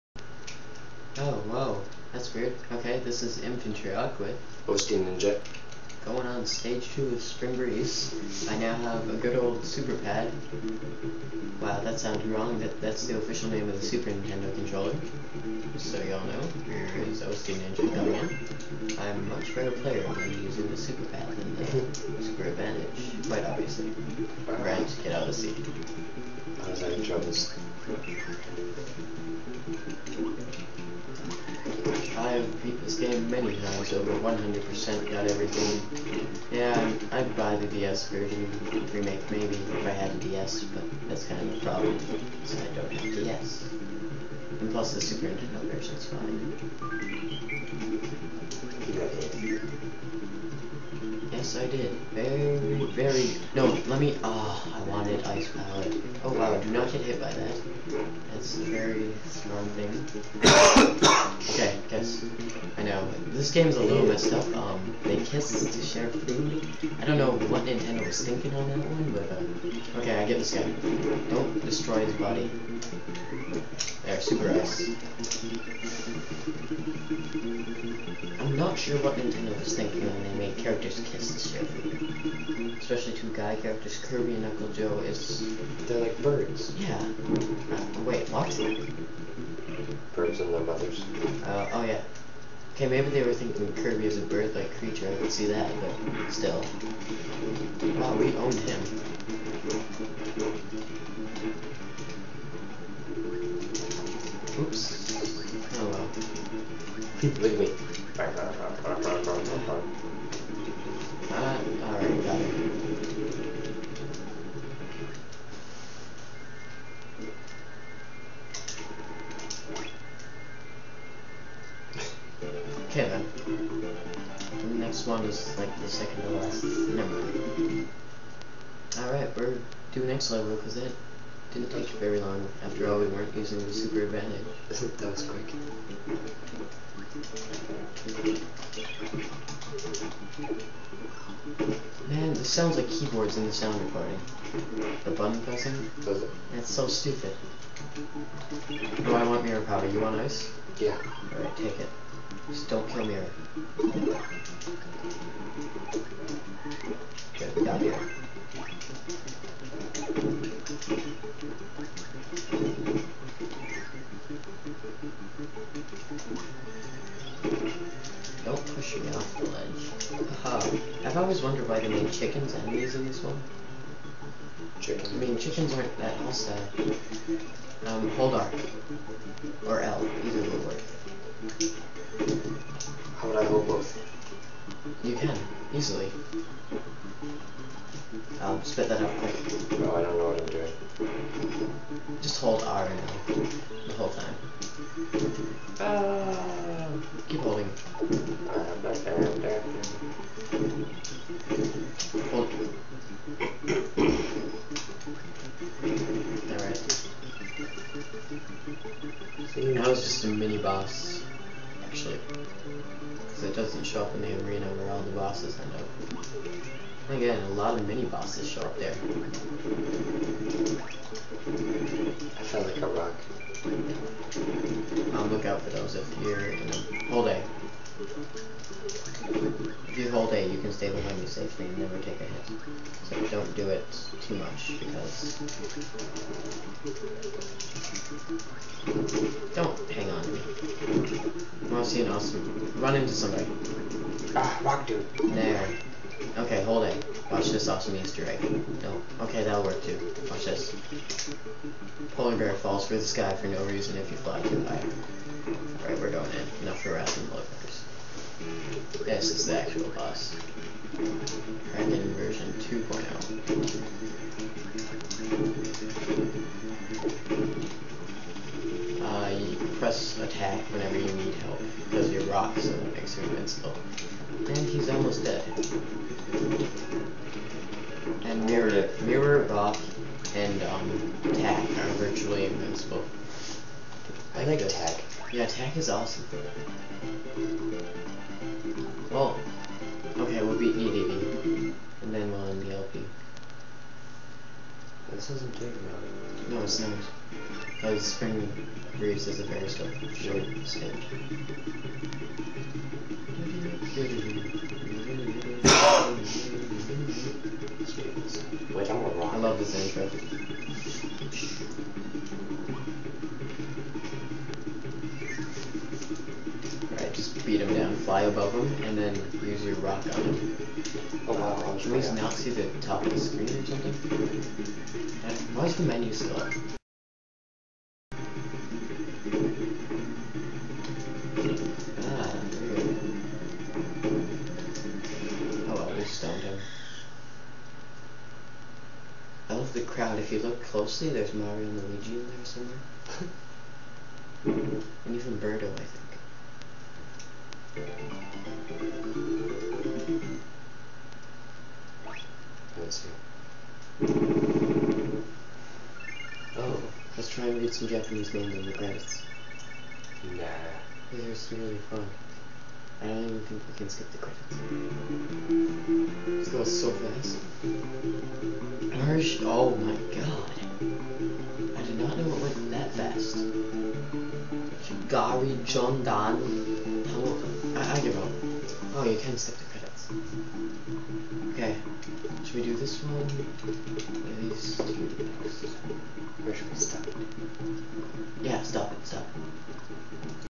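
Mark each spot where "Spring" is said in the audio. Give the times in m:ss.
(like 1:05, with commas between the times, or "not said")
0:07, 4:58.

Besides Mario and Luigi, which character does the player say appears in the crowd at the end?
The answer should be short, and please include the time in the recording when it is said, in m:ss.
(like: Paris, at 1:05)
Birdo, at 5:45.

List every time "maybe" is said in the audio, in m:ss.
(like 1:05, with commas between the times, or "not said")
0:39, 1:32.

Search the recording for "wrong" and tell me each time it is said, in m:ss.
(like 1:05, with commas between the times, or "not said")
0:12, 5:09.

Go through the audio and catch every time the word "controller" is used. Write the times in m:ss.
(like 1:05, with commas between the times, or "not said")
0:14.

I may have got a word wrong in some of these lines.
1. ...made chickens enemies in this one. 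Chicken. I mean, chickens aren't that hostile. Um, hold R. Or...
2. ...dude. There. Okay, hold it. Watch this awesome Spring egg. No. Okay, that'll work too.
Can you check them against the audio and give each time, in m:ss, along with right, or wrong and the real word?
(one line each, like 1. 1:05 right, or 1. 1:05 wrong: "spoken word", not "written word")
1. 2:51 right
2. 4:04 wrong: "Easter", not "Spring".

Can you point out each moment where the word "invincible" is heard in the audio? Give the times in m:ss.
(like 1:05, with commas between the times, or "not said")
4:33, 4:42.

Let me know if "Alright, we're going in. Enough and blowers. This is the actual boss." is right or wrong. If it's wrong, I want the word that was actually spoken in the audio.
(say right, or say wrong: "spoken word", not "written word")
right.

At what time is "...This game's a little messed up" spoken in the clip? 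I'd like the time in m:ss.
1:03.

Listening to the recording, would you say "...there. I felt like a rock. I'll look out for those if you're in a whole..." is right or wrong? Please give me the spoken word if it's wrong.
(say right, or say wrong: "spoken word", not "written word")
right.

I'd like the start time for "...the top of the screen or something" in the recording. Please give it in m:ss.
5:22.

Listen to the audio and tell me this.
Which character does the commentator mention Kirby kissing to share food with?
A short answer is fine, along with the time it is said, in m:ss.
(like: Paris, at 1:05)
Uncle Joe, at 1:24.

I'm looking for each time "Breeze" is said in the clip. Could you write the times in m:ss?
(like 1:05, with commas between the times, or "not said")
0:07, 4:58.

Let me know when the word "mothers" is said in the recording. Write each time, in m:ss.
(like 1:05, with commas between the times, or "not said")
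1:30.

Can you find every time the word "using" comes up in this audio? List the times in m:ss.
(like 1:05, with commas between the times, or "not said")
0:20, 2:13.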